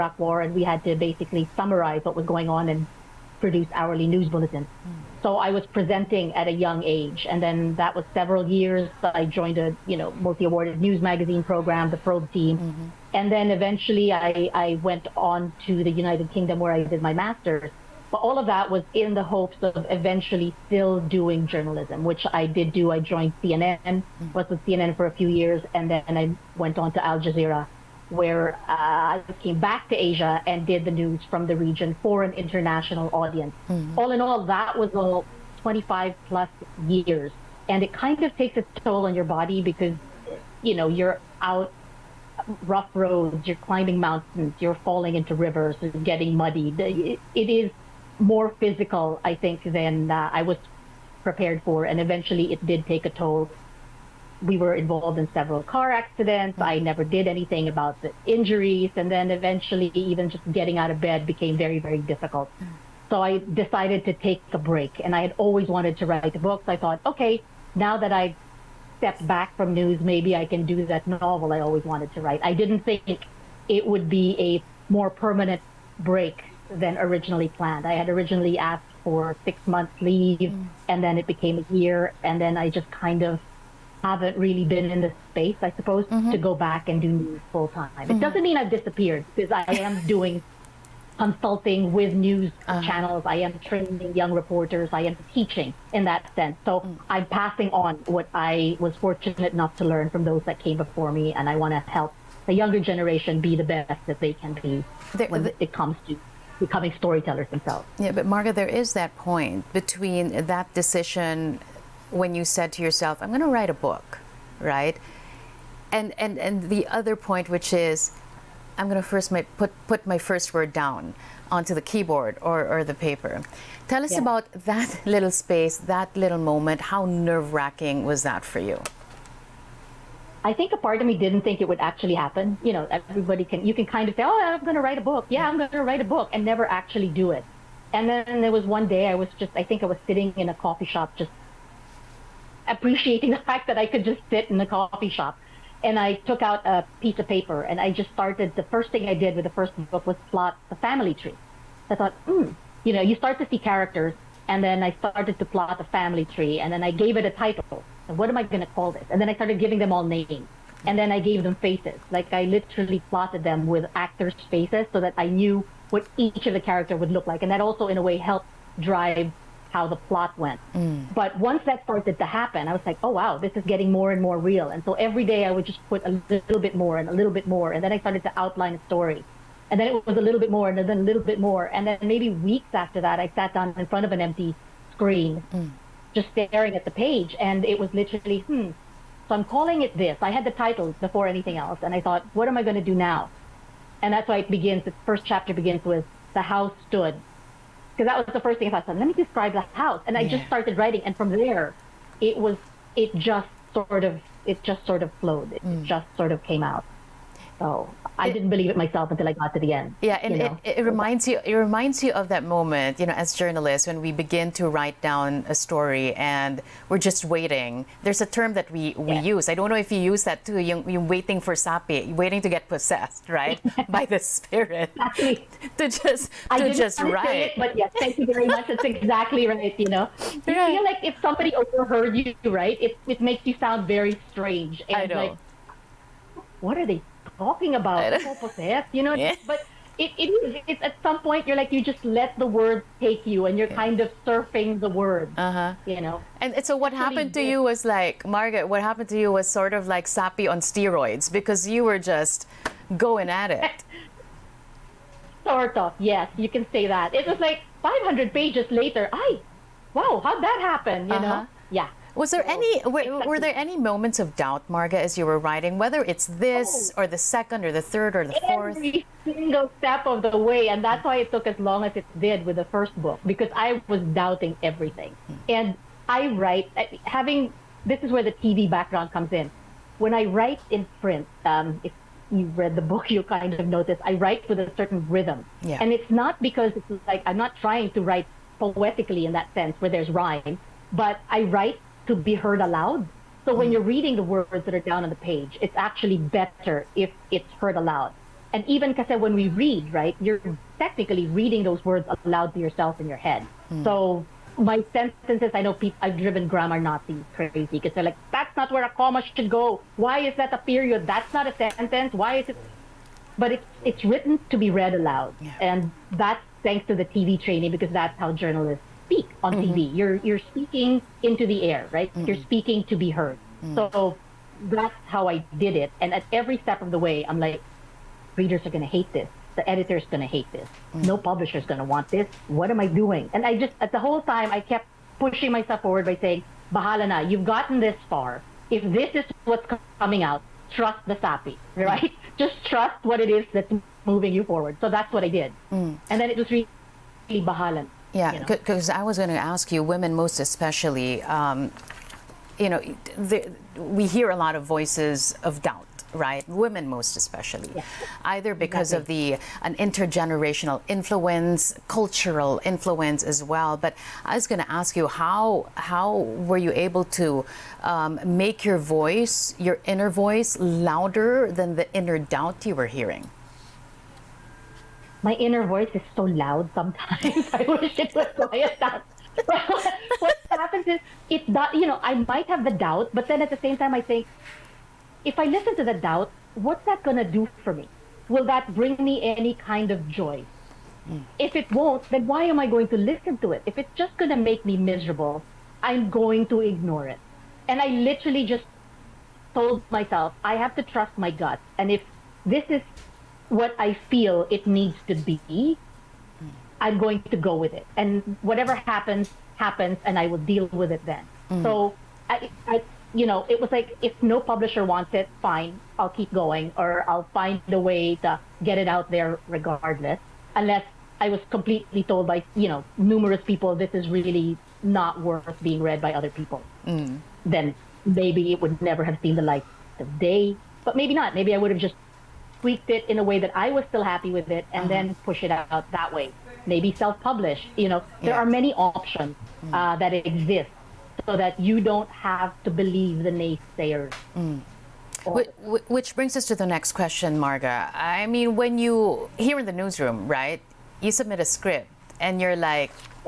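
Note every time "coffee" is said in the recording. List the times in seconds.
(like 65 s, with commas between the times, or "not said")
140 s, 144 s.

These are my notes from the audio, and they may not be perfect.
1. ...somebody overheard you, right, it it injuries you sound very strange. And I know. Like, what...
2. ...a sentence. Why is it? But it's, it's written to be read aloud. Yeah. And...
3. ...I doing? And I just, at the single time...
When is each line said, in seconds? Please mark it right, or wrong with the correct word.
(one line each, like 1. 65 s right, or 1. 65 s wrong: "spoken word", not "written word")
1. 231 s wrong: "makes", not "injuries"
2. 311 s right
3. 332 s wrong: "whole", not "single".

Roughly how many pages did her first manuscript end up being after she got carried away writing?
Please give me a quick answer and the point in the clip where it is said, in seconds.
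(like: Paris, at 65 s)
500, at 257 s.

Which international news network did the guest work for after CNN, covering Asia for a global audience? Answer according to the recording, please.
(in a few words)
Al Jazeera.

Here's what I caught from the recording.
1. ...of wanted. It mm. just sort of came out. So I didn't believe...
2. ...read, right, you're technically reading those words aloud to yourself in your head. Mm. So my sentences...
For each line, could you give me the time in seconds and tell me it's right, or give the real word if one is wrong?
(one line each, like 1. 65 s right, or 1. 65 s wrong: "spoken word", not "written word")
1. 205 s wrong: "flowed", not "wanted"
2. 299 s right.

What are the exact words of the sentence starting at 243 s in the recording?
kind of surfing the word, uh-huh.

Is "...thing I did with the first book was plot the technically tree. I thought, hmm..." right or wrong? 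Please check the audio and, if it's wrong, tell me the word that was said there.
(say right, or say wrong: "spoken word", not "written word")
wrong: "family", not "technically".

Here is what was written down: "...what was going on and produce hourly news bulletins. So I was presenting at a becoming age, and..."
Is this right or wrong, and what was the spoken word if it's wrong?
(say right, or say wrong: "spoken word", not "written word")
wrong: "young", not "becoming".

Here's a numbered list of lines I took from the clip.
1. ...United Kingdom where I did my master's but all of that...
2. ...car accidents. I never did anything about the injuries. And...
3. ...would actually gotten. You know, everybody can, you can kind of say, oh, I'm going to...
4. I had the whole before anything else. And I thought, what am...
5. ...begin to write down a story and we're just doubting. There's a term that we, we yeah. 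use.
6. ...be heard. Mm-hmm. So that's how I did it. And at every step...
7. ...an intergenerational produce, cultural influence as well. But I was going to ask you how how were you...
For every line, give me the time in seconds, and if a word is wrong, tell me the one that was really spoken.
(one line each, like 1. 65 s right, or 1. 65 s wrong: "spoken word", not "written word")
1. 15 s right
2. 55 s right
3. 131 s wrong: "happen", not "gotten"
4. 190 s wrong: "title", not "whole"
5. 214 s wrong: "waiting", not "doubting"
6. 322 s right
7. 359 s wrong: "influence", not "produce".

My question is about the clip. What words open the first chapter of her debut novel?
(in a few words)
The house stood.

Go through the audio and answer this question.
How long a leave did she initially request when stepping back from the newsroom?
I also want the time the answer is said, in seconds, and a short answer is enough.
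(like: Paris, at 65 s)
6 months, at 79 s.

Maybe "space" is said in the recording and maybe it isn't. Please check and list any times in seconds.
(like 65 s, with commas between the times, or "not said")
85 s, 125 s.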